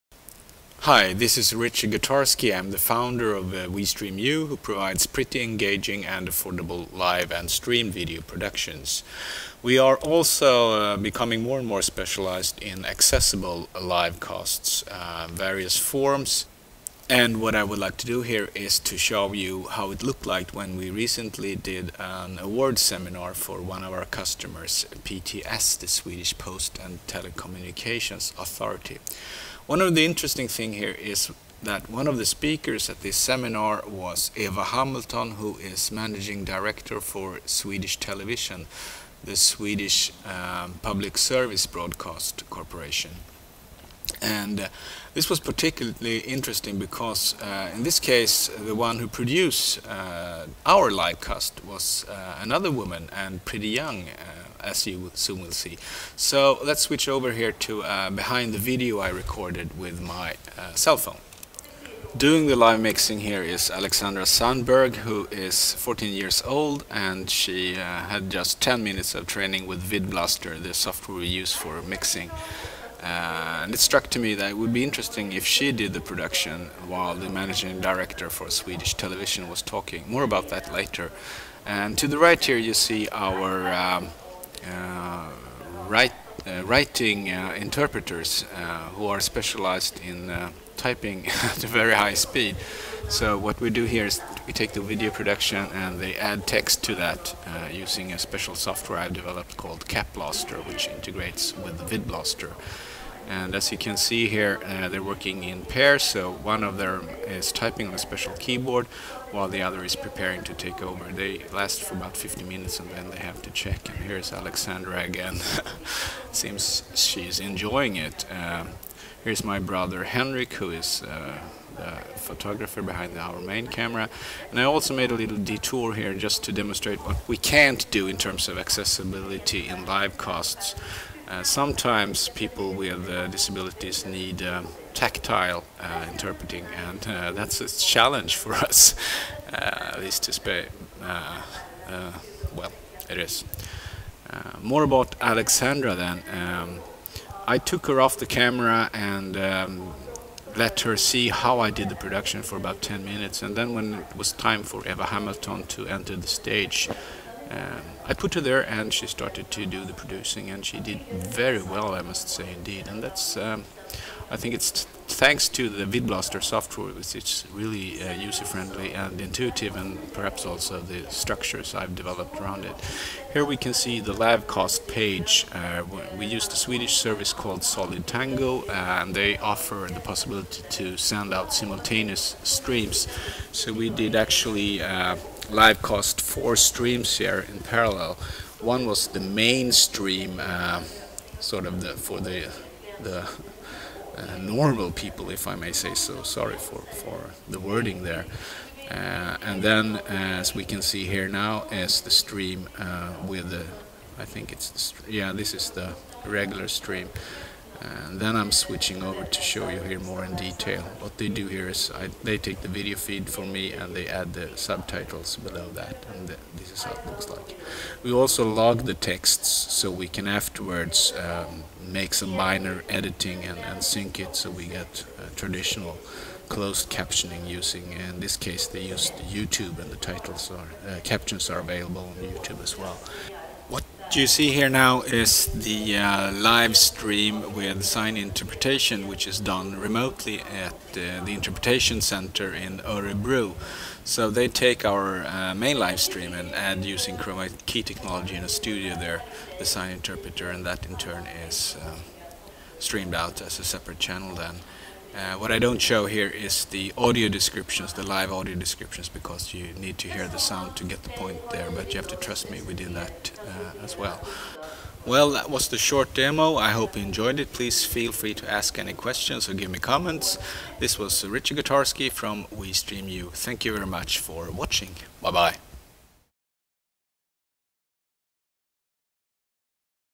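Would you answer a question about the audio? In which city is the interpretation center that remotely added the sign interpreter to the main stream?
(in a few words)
Örebro.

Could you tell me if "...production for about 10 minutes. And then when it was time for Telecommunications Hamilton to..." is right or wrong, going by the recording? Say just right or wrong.
wrong.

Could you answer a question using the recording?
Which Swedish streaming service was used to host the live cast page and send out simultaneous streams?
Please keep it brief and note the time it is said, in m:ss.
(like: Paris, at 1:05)
Solidtango, at 2:57.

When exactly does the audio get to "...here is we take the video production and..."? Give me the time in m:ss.
1:33.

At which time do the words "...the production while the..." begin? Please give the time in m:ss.
1:15.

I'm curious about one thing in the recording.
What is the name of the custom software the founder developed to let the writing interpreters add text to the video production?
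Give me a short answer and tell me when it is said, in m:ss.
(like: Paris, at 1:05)
CapBlaster, at 1:39.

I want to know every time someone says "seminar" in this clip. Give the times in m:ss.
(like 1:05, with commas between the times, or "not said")
0:22, 0:33.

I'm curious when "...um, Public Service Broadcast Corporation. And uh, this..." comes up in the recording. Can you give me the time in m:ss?
0:40.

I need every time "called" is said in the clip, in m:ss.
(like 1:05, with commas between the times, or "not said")
1:39, 2:57.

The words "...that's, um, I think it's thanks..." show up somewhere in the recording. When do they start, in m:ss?
2:43.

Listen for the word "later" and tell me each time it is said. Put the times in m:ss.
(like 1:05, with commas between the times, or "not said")
1:20.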